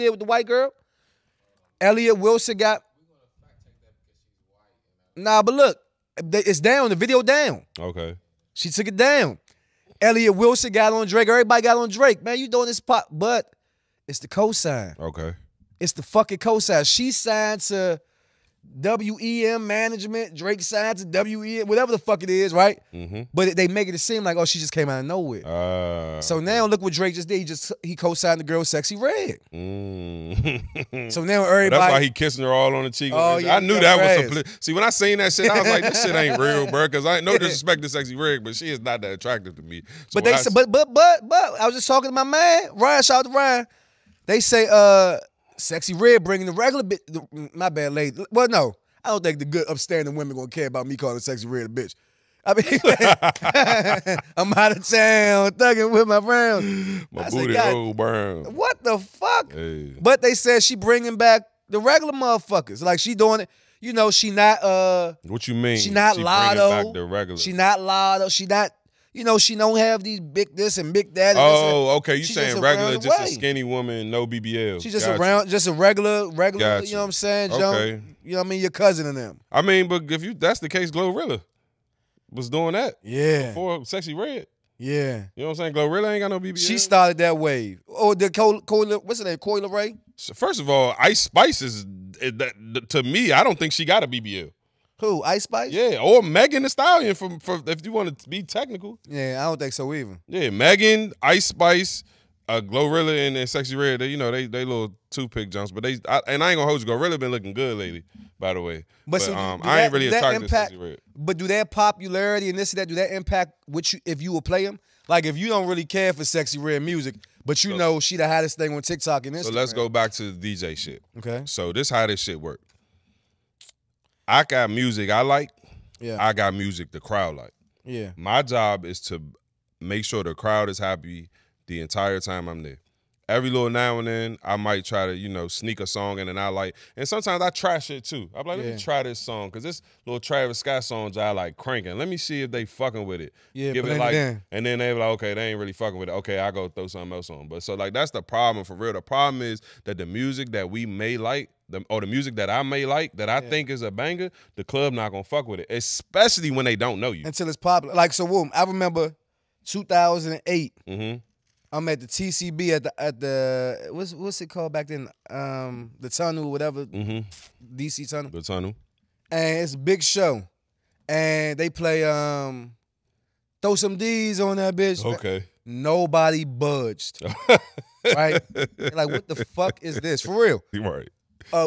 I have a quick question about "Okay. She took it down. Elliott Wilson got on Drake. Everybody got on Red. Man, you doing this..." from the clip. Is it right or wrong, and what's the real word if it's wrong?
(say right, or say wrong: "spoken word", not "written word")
wrong: "Drake", not "Red".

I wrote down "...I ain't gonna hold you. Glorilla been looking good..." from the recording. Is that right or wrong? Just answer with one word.
right.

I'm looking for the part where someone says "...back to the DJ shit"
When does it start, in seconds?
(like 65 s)
119 s.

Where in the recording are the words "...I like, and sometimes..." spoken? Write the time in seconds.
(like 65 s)
136 s.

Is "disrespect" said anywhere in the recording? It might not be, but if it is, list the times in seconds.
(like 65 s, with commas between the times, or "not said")
37 s.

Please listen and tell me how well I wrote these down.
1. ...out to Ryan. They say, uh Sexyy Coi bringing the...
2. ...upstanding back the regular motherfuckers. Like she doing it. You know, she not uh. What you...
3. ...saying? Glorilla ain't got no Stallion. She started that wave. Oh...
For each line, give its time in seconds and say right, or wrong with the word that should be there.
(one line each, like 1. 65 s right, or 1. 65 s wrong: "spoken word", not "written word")
1. 43 s wrong: "Red", not "Coi"
2. 60 s wrong: "bringing", not "upstanding"
3. 85 s wrong: "BBL", not "Stallion".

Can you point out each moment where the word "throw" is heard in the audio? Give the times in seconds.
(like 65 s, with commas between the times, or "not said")
146 s, 173 s.